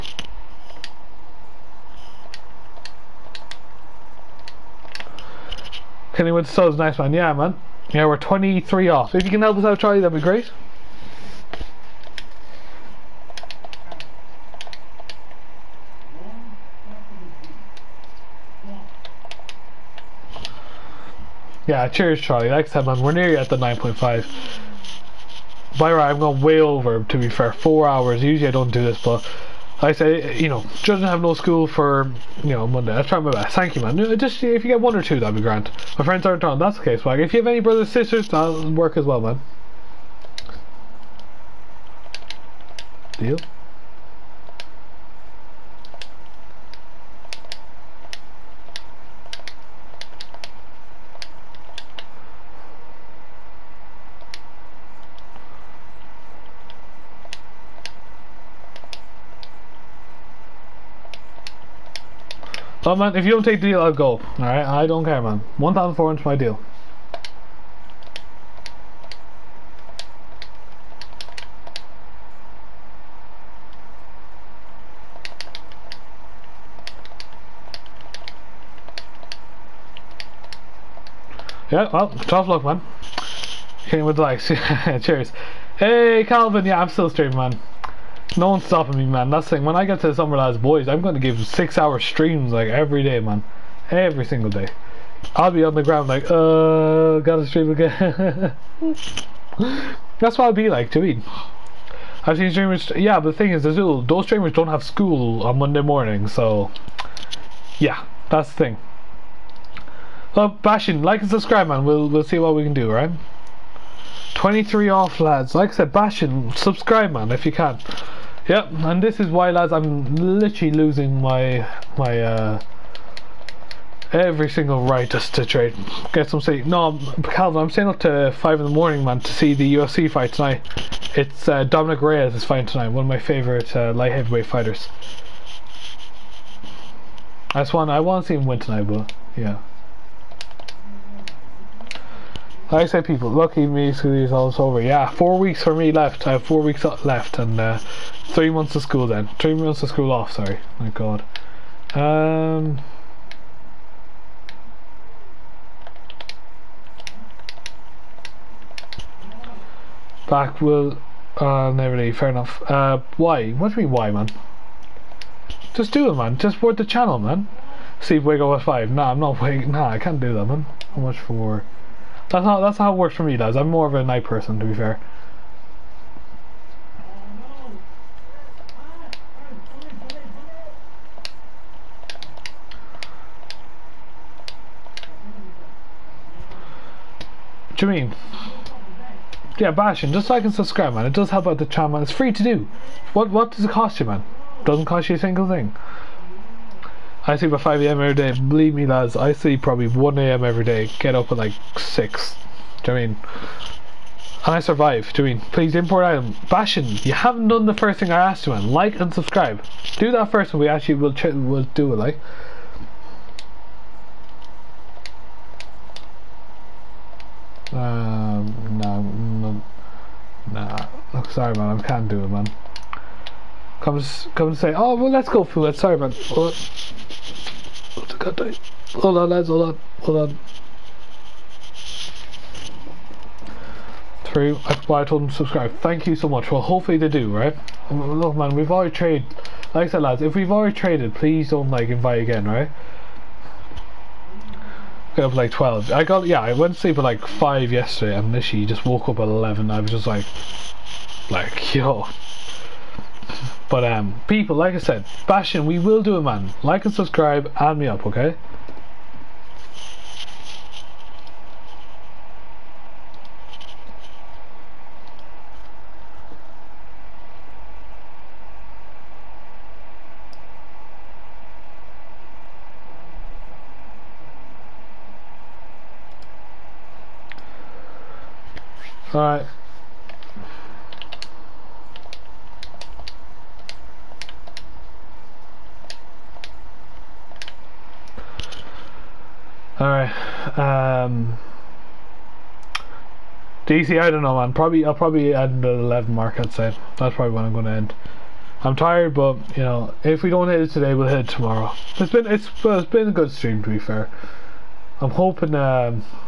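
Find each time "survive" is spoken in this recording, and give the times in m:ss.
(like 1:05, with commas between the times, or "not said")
3:24.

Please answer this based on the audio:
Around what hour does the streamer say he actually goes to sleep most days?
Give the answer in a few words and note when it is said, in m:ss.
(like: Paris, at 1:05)
1 a.m., at 3:19.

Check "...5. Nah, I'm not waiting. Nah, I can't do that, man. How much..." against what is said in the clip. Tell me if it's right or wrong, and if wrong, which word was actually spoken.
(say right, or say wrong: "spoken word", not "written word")
right.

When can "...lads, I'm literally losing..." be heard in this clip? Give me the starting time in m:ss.
1:59.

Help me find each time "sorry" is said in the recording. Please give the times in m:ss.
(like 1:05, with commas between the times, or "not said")
2:30, 3:41, 3:45.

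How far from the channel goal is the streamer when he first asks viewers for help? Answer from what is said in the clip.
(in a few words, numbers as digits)
23.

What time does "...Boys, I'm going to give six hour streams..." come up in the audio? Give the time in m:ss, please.
1:30.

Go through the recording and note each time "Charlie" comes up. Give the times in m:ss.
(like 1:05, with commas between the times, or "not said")
0:09, 0:22.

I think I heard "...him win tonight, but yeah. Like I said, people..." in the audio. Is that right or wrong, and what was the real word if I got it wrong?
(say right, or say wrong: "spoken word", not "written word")
right.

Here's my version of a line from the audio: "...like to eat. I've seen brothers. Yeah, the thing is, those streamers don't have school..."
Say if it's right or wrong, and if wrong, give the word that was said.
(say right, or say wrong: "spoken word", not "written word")
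wrong: "streamers", not "brothers".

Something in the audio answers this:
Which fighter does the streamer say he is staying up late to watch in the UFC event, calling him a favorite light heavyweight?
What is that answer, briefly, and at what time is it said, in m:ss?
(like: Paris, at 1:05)
Dominick Reyes, at 2:11.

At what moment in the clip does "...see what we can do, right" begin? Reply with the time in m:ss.
1:52.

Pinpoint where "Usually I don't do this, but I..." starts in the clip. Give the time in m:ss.
0:28.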